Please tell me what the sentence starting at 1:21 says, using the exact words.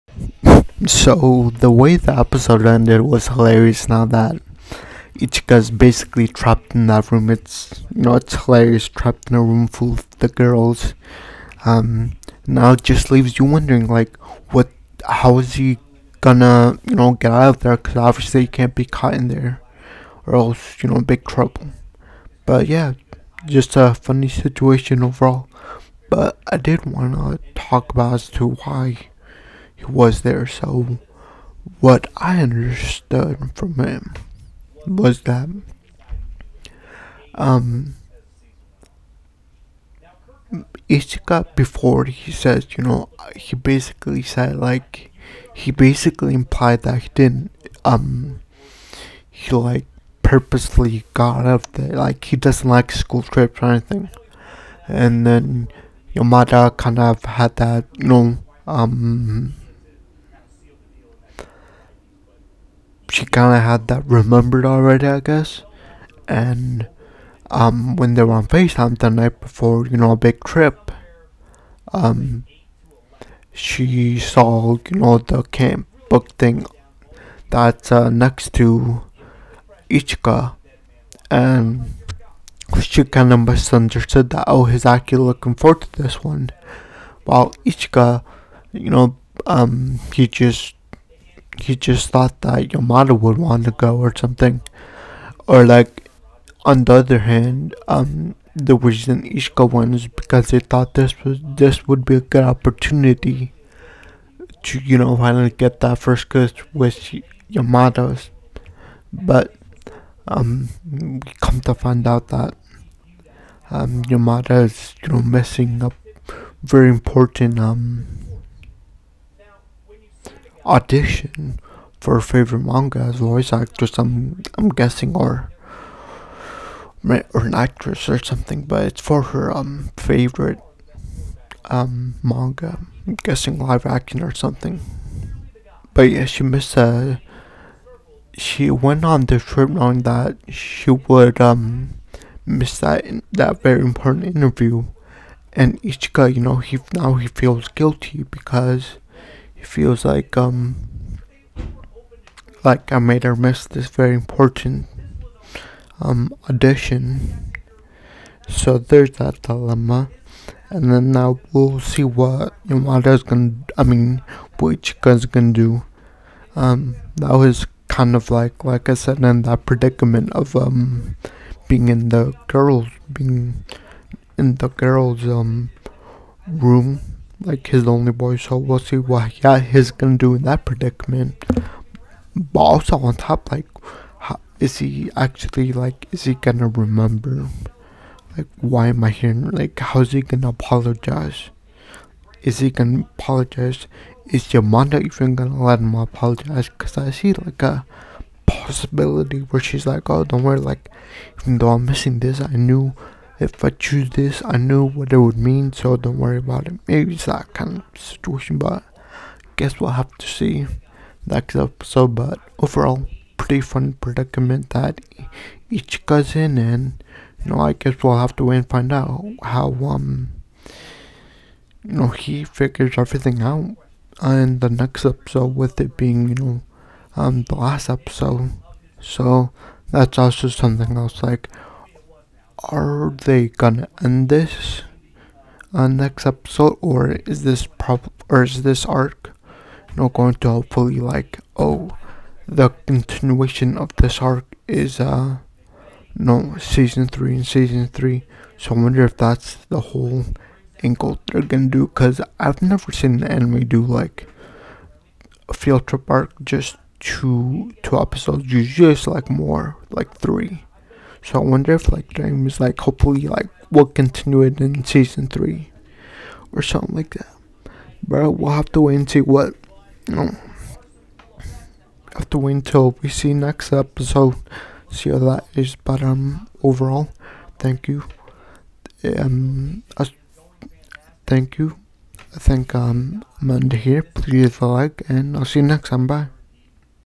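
And she kind of misunderstood that, oh, he's actually looking forward to this one.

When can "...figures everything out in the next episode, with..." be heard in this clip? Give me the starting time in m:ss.
3:42.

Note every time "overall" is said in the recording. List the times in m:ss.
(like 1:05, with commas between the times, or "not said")
0:25, 3:32, 4:36.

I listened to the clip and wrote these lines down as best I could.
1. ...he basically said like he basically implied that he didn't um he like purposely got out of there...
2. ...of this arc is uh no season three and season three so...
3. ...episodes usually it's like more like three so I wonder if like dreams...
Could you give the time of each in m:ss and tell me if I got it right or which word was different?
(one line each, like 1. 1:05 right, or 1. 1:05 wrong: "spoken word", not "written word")
1. 0:43 right
2. 4:03 right
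3. 4:17 right.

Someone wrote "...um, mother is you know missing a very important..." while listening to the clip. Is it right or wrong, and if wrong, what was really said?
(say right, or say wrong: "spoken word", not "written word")
right.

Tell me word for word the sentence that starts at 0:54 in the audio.
And then Yamada kind of had that, you know, um kind of had that remembered already, I guess.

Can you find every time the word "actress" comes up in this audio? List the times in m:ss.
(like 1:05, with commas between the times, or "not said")
2:03, 2:07.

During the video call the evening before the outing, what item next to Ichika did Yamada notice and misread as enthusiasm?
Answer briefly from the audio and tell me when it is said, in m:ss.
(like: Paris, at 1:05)
camp book, at 1:15.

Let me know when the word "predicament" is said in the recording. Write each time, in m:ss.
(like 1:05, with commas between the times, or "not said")
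2:49, 3:00, 3:33.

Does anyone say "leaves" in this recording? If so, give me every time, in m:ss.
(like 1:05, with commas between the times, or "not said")
0:13, 4:44.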